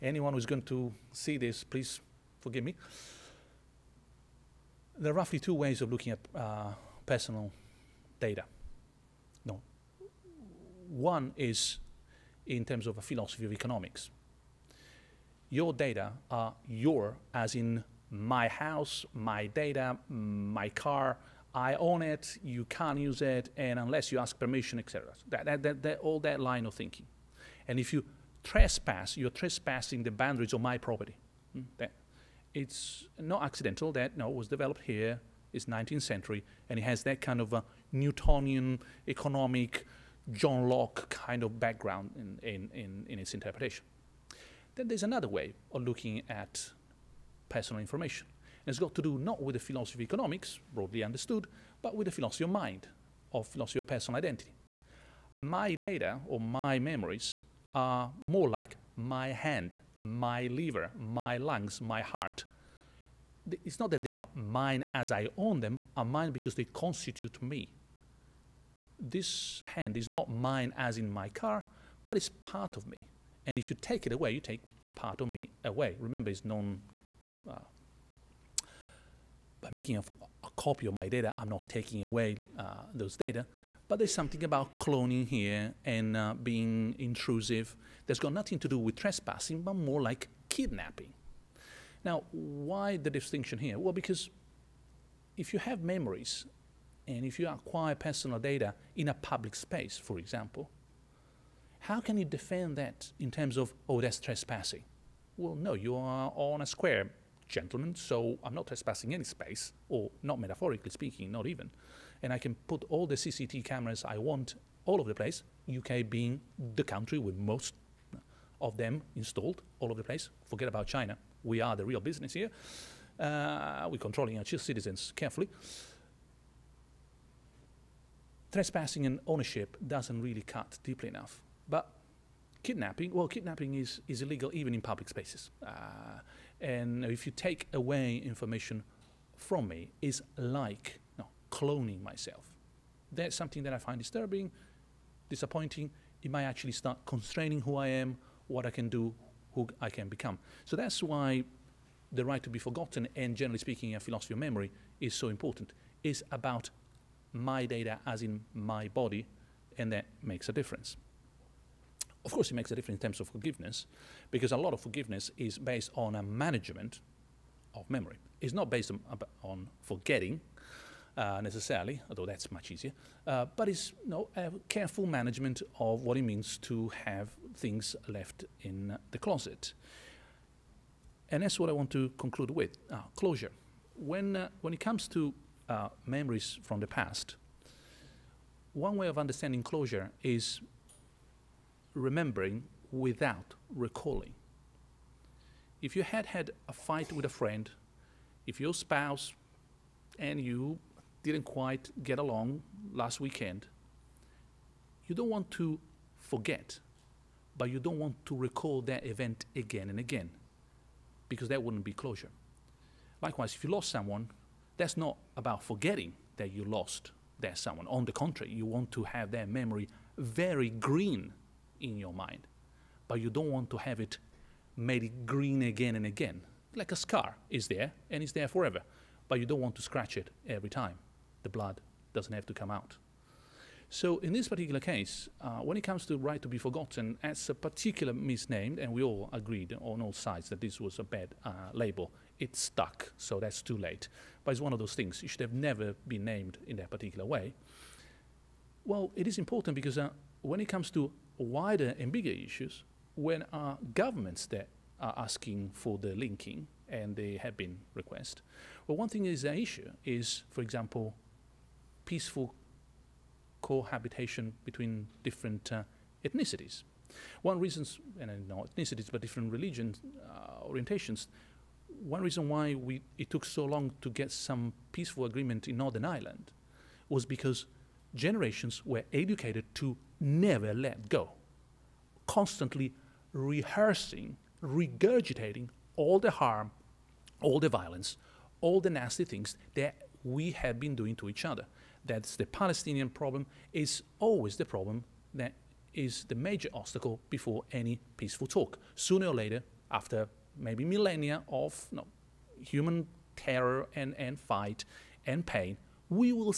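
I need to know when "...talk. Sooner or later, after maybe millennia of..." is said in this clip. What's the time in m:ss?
4:58.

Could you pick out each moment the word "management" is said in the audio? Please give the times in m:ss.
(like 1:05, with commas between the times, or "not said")
2:46, 2:55.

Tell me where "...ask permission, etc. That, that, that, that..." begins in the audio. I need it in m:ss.
0:24.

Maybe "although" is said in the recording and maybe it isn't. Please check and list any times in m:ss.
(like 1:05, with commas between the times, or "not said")
2:52.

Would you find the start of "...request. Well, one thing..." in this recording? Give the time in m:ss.
4:17.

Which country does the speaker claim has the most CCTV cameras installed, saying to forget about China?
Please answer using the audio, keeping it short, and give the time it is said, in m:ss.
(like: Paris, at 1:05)
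UK, at 1:55.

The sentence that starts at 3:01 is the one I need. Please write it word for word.
And that's what I want to conclude with, uh, closure.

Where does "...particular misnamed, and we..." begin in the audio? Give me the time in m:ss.
3:57.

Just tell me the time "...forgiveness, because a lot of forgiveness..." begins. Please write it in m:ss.
2:43.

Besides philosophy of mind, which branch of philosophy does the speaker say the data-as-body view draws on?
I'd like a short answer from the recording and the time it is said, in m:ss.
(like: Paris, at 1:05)
personal identity, at 0:53.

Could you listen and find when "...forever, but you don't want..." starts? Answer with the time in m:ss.
3:48.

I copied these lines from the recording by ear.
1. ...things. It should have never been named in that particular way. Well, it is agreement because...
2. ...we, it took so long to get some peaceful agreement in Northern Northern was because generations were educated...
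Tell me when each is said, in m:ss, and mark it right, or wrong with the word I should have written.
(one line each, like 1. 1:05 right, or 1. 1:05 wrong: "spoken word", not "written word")
1. 4:04 wrong: "important", not "agreement"
2. 4:32 wrong: "Ireland", not "Northern".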